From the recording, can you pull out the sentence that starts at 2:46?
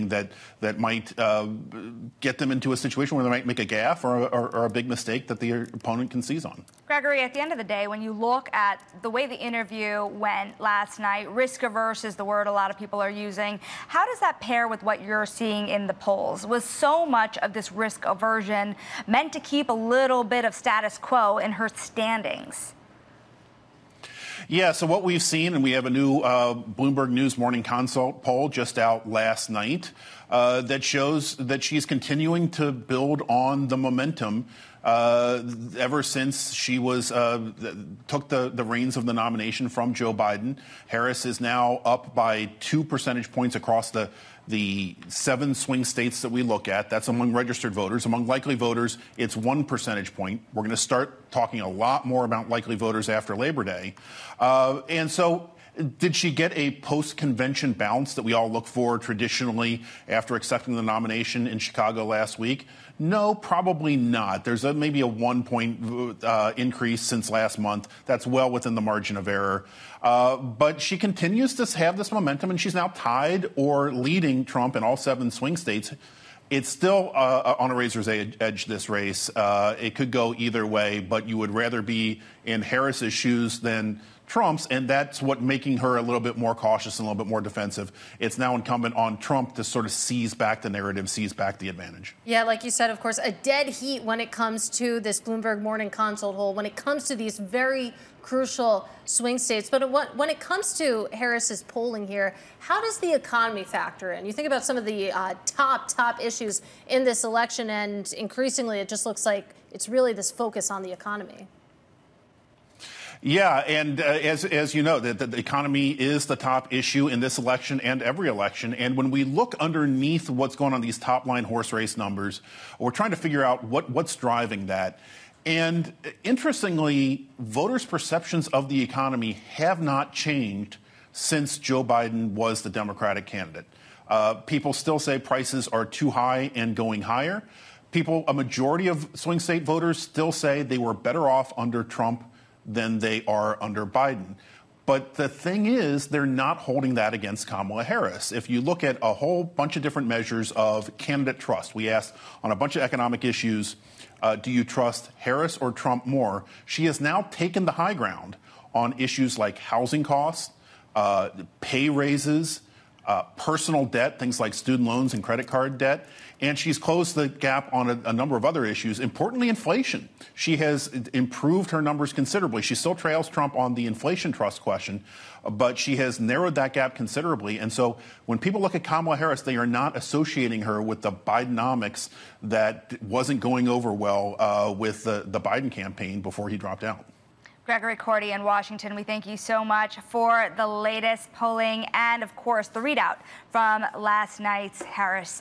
And she's closed the gap on a, a, number of other issues, importantly, inflation.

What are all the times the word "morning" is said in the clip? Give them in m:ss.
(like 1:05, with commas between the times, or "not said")
0:27, 1:35.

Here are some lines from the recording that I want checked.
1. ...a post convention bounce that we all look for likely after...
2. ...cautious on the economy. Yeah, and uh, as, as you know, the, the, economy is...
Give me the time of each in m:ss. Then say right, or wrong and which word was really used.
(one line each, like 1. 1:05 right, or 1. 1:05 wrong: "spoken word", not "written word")
1. 0:56 wrong: "traditionally", not "likely"
2. 1:50 wrong: "focus", not "cautious".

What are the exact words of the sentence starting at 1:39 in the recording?
But when it comes to Harris's polling here, how does the economy factor in?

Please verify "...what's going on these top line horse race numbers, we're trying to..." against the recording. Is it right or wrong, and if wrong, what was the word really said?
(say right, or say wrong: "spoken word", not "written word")
right.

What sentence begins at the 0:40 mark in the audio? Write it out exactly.
Harris is now up by two percentage points across the the seven swing states that we look at.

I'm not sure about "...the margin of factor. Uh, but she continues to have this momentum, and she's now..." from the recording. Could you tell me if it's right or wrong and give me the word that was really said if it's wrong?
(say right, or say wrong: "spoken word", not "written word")
wrong: "error", not "factor".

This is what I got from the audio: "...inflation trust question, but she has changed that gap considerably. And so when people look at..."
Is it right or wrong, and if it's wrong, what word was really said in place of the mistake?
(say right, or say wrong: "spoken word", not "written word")
wrong: "narrowed", not "changed".